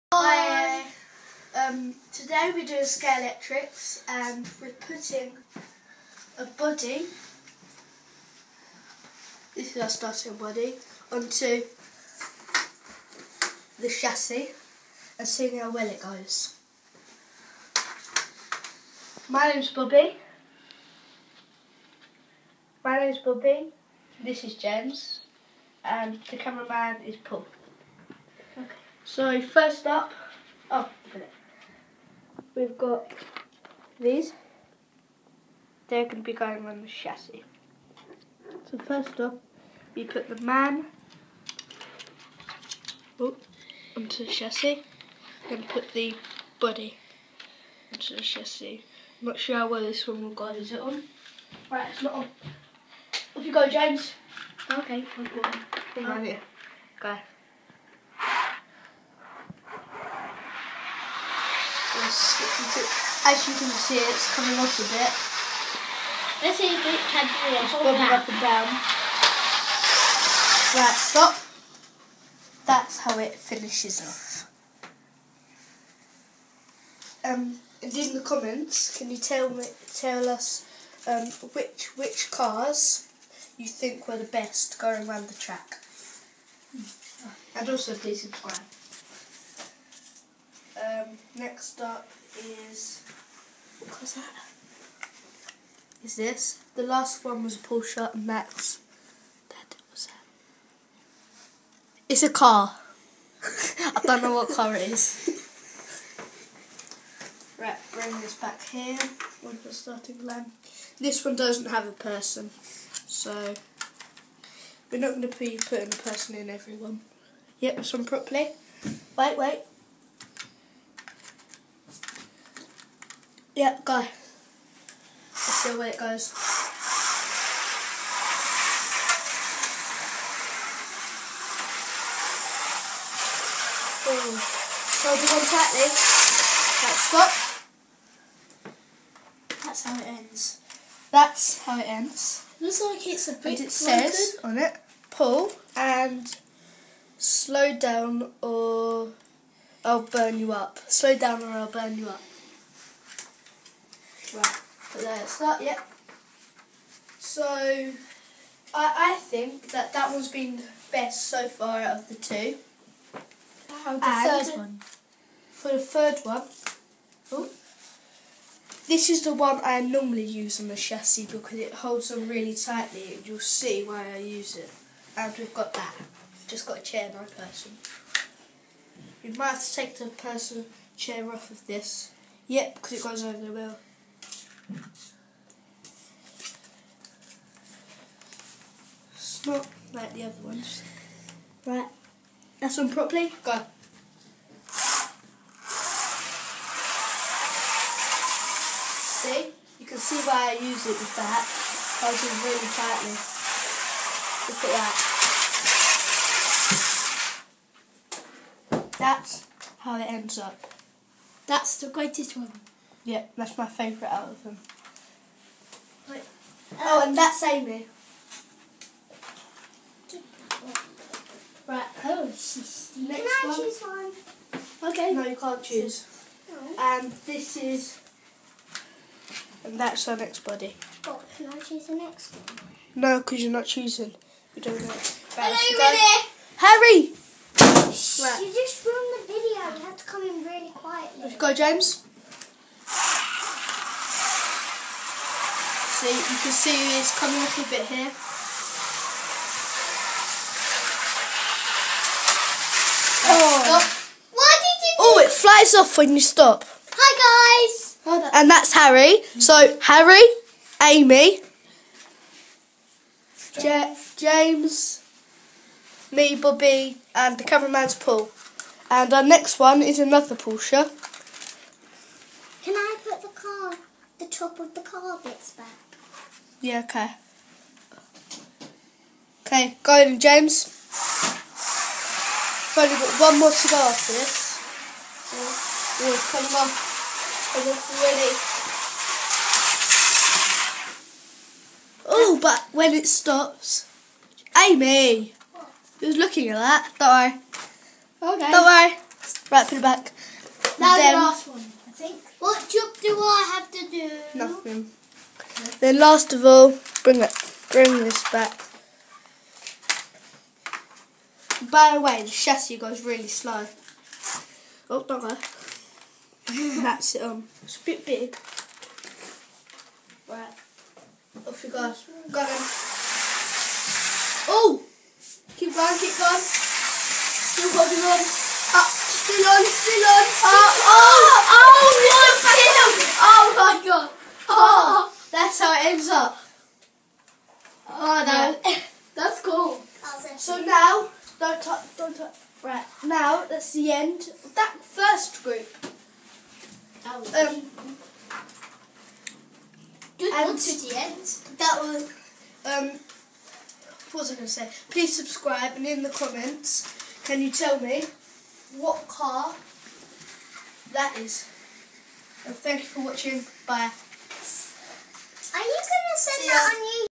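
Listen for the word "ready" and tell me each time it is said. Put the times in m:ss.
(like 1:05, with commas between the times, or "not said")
3:55, 4:48.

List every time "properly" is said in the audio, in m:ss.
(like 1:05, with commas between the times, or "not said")
1:58, 3:12.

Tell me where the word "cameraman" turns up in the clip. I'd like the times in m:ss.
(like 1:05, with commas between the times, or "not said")
0:26, 4:27.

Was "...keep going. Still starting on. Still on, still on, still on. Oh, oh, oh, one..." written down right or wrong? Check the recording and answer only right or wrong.
wrong.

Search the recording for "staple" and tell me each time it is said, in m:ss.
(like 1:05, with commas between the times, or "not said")
not said.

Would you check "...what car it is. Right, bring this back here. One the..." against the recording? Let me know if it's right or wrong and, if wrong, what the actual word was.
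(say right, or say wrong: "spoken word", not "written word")
right.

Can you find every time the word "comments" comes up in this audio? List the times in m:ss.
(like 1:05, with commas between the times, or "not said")
1:18, 5:56.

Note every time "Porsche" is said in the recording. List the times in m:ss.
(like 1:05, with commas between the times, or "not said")
1:37, 4:30.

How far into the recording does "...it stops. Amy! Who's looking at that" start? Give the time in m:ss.
4:52.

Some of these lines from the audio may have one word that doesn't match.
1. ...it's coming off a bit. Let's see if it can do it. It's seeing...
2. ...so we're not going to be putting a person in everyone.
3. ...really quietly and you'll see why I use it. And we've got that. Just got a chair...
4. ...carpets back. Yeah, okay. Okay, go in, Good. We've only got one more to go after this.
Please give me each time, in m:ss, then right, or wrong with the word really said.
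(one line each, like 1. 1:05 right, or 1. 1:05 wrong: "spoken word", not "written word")
1. 1:03 wrong: "bobbing", not "seeing"
2. 1:53 right
3. 2:52 wrong: "tightly", not "quietly"
4. 4:34 wrong: "James", not "Good".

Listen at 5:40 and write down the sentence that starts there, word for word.
So now, don't touch, don't touch.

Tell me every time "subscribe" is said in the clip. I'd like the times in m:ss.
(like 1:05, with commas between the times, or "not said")
1:28, 5:55.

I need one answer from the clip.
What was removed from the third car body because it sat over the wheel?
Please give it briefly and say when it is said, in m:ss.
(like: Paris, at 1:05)
The person chair, at 3:00.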